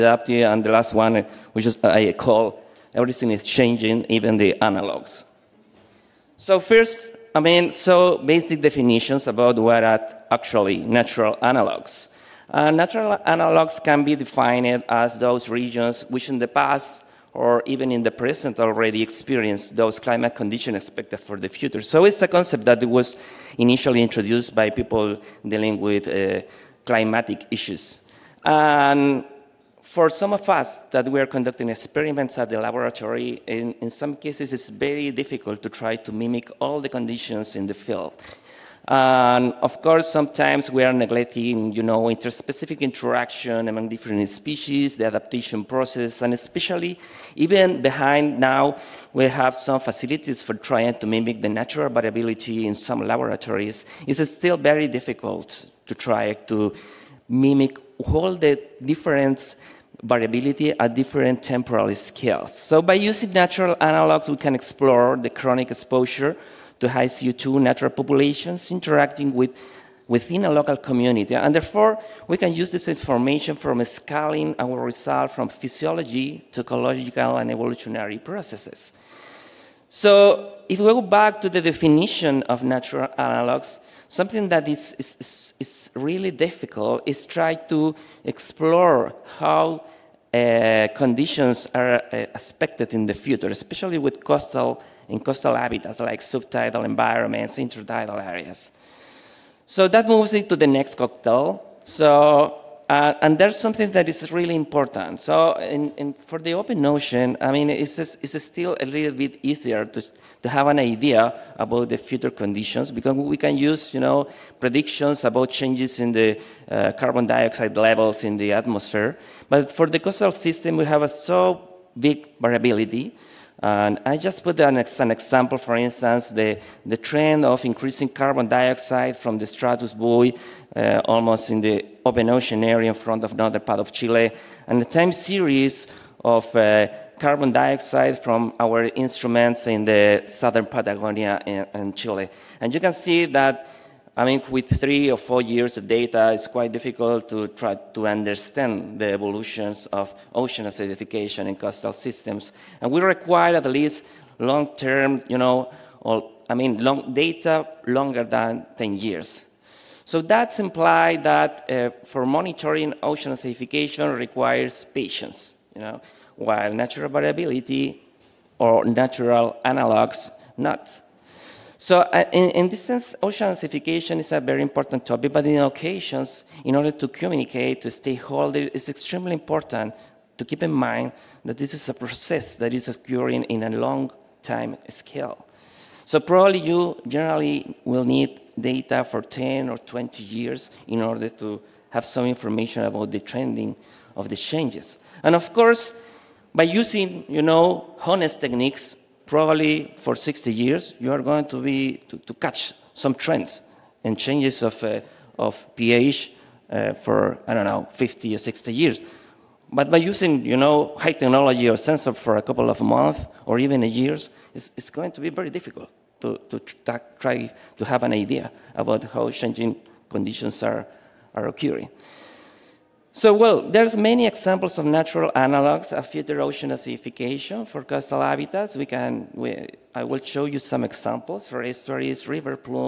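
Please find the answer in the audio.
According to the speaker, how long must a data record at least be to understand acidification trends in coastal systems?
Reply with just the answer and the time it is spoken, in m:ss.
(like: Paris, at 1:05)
Longer than 10 years, at 2:37.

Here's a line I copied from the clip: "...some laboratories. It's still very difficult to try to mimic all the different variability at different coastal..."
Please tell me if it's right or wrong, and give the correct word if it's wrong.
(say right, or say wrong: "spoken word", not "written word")
wrong: "temporal", not "coastal".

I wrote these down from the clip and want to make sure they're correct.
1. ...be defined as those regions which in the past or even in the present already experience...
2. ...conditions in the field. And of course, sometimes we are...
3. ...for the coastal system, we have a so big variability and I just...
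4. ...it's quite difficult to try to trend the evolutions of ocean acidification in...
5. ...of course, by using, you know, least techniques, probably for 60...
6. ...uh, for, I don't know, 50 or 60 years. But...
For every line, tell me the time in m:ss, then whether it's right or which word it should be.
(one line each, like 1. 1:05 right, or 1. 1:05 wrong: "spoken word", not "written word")
1. 0:14 right
2. 0:36 right
3. 1:59 right
4. 2:26 wrong: "understand", not "trend"
5. 3:15 wrong: "honest", not "least"
6. 3:26 right.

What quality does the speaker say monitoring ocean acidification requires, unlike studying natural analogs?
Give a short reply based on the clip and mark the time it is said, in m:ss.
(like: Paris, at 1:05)
Patience, at 2:44.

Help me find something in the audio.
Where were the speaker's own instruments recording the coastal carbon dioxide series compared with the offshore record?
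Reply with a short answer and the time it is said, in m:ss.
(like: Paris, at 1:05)
Southern Patagonia, at 2:20.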